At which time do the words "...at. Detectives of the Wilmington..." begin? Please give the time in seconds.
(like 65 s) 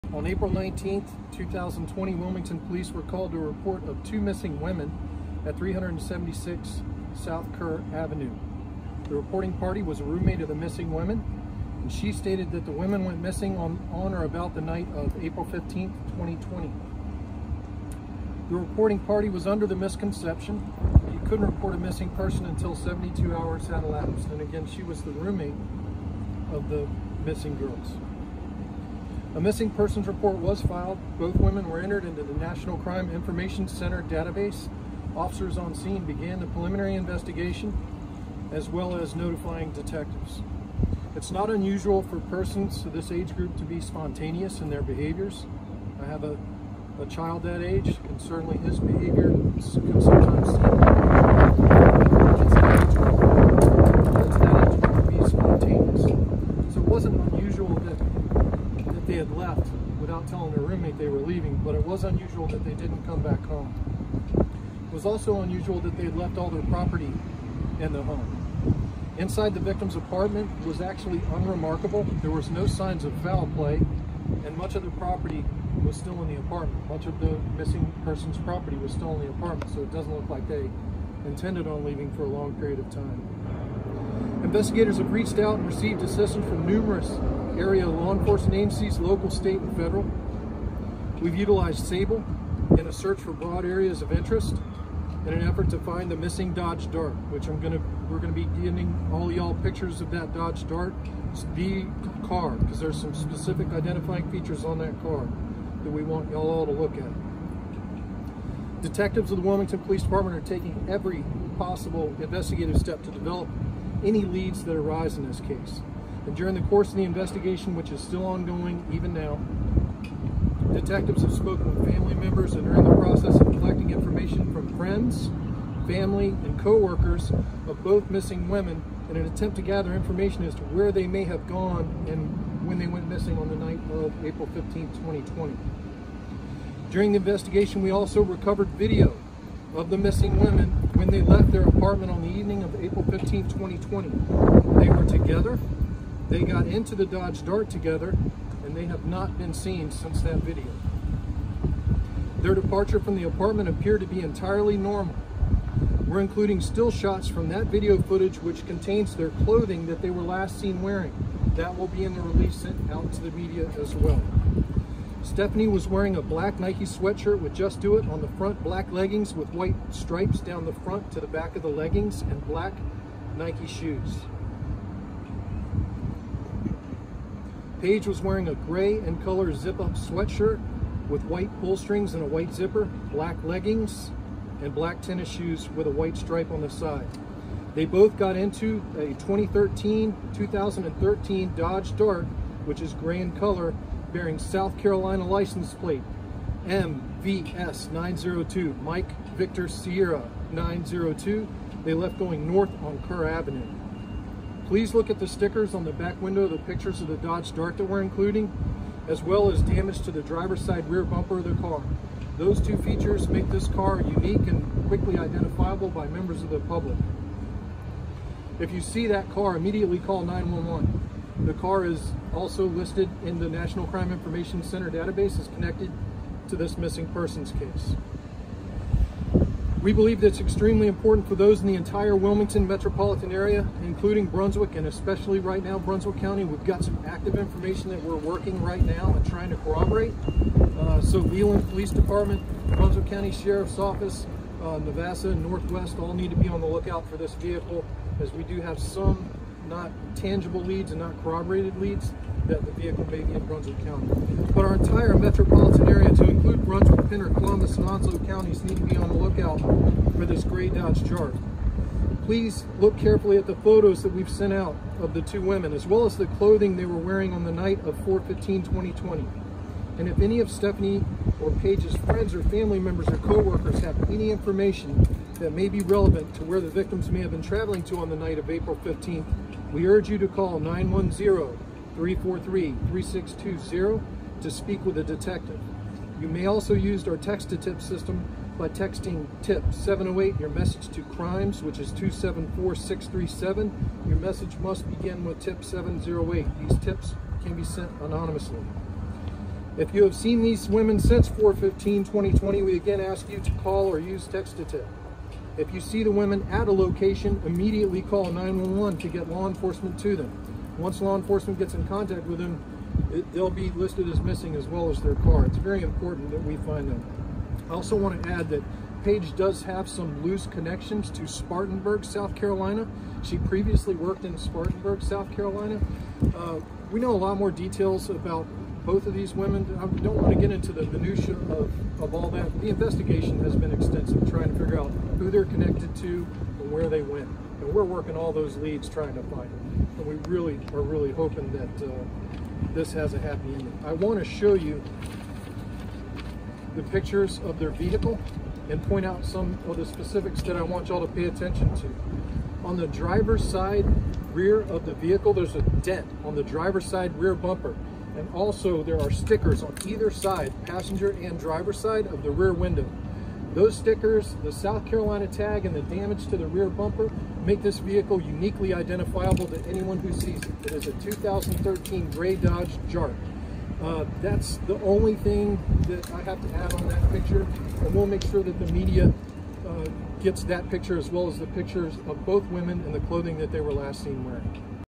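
106 s.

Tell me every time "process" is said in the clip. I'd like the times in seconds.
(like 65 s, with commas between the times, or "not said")
122 s.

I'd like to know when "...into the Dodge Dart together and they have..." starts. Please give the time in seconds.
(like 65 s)
146 s.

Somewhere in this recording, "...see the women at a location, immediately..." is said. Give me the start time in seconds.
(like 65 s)
305 s.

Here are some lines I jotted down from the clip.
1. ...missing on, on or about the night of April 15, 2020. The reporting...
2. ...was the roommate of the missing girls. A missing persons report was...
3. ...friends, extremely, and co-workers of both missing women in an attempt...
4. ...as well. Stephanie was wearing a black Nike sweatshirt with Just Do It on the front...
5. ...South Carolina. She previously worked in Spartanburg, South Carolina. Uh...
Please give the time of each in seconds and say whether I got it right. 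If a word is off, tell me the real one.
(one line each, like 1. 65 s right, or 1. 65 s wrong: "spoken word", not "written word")
1. 13 s right
2. 24 s right
3. 124 s wrong: "family", not "extremely"
4. 163 s right
5. 322 s right.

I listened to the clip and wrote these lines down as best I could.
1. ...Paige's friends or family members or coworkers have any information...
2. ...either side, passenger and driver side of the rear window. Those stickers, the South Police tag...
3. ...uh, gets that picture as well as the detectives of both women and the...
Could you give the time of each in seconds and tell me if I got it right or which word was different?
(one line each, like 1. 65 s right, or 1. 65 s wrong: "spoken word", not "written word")
1. 271 s right
2. 359 s wrong: "Carolina", not "Police"
3. 379 s wrong: "pictures", not "detectives".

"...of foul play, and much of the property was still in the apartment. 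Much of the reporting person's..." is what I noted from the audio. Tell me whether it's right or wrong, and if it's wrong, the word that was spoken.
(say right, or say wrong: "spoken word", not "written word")
wrong: "missing", not "reporting".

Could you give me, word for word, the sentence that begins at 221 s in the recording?
The car is also listed in the National Crime Information Center database as connected to this missing persons case.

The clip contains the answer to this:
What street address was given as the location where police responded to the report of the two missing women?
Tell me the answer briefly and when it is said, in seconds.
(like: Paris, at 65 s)
376 South Kerr Avenue, at 5 s.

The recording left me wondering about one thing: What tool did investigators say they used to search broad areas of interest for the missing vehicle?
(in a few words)
Sable.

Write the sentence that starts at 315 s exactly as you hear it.
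It's very important that we find them.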